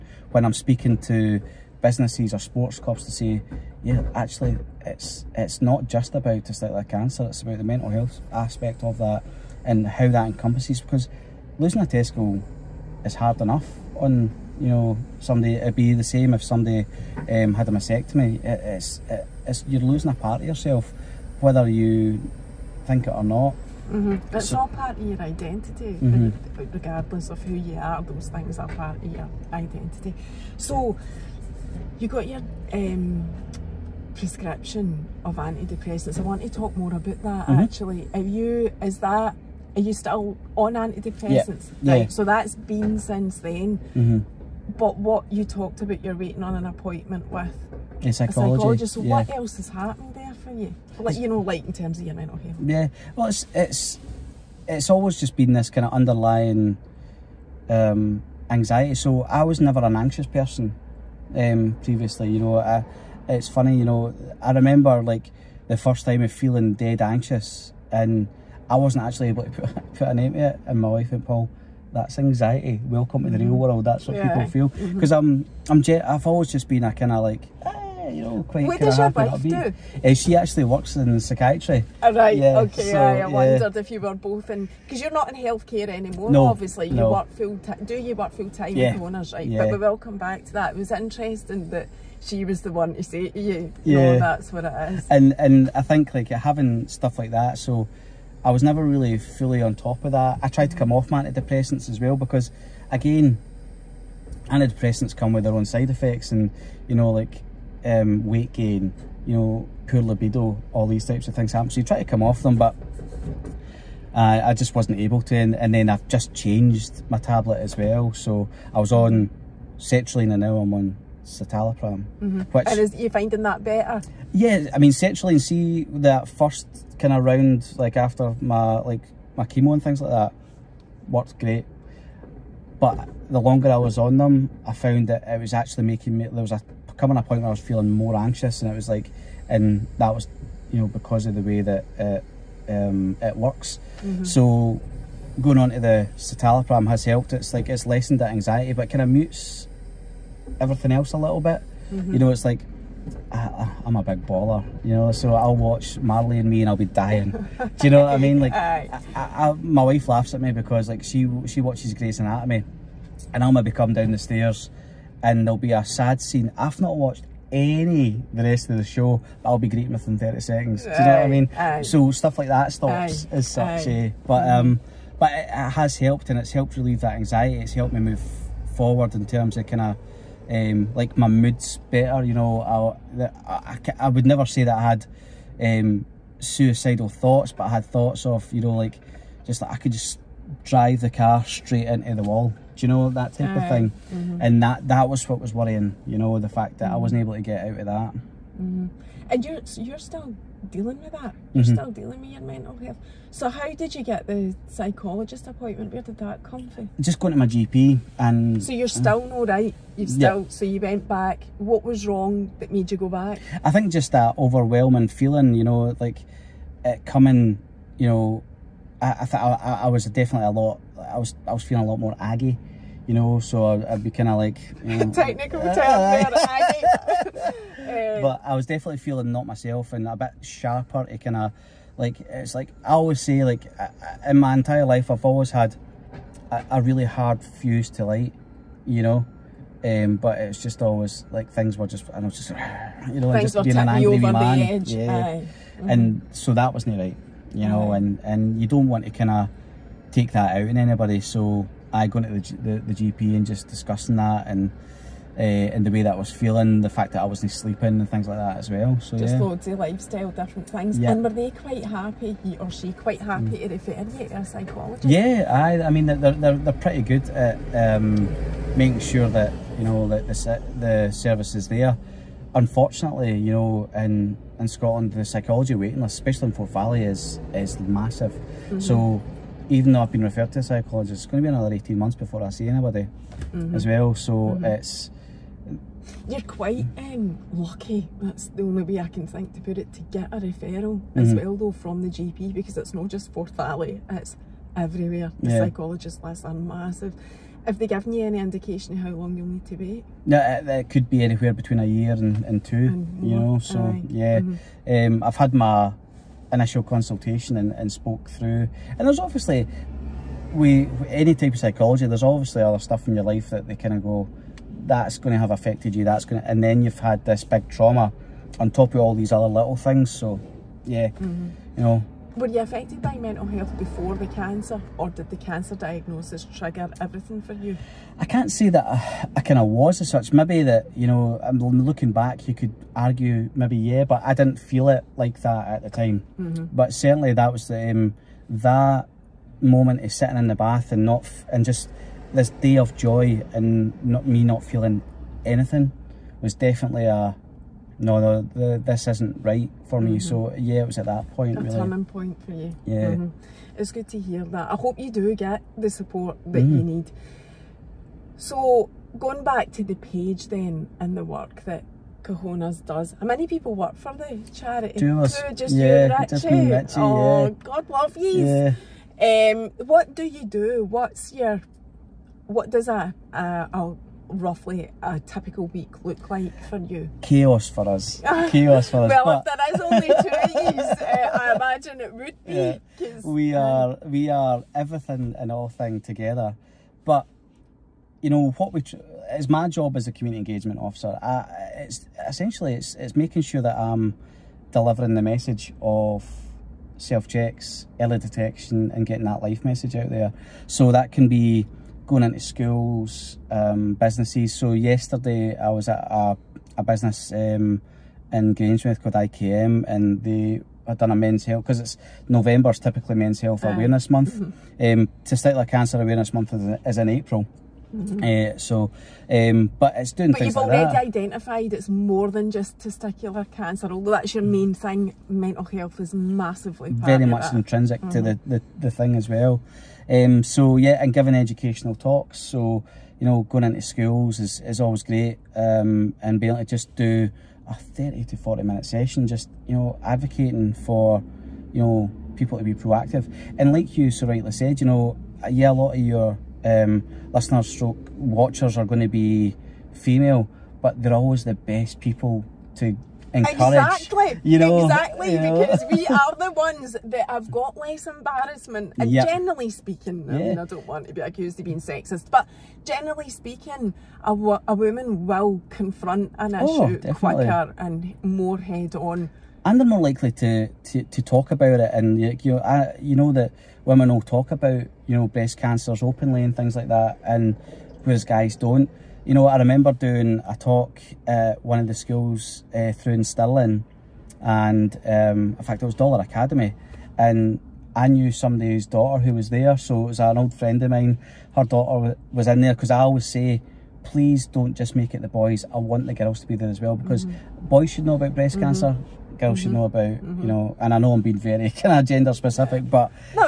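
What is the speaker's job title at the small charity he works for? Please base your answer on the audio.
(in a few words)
Community engagement officer.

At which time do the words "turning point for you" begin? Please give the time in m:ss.
5:51.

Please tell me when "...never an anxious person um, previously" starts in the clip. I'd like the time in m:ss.
0:59.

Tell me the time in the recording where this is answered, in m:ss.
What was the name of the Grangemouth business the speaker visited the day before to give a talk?
6:49.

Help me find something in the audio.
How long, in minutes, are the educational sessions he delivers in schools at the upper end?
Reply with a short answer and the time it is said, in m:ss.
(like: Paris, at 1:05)
40, at 7:18.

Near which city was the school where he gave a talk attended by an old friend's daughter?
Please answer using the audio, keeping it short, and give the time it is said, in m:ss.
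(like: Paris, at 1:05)
Stirling, at 8:03.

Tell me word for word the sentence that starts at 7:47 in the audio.
quicker and more head on and they're more likely to, to, to talk about it.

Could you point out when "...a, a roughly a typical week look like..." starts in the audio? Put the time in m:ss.
6:13.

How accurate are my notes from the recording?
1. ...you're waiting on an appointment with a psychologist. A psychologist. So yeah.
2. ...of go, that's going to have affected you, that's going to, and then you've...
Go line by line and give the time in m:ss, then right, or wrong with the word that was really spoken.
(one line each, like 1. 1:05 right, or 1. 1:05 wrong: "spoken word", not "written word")
1. 0:46 right
2. 5:13 right.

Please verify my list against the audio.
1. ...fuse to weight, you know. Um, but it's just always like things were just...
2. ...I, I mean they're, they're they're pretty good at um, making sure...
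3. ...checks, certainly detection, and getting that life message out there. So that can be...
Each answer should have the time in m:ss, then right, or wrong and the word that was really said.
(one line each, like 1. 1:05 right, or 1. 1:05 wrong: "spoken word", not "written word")
1. 3:57 wrong: "light", not "weight"
2. 4:25 right
3. 6:37 wrong: "early", not "certainly".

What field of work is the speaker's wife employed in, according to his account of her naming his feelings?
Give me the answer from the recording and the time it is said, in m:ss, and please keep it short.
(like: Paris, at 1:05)
Psychiatry, at 1:21.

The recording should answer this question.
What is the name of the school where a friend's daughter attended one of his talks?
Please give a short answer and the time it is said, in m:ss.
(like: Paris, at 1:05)
Dollar Academy, at 8:05.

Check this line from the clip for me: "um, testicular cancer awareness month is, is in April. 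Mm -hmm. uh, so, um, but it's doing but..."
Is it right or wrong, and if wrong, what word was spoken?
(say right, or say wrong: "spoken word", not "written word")
right.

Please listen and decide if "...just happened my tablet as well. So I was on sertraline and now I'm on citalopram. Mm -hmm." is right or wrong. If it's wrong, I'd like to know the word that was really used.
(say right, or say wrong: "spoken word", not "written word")
wrong: "changed", not "happened".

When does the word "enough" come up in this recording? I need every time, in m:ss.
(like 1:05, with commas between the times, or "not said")
0:13.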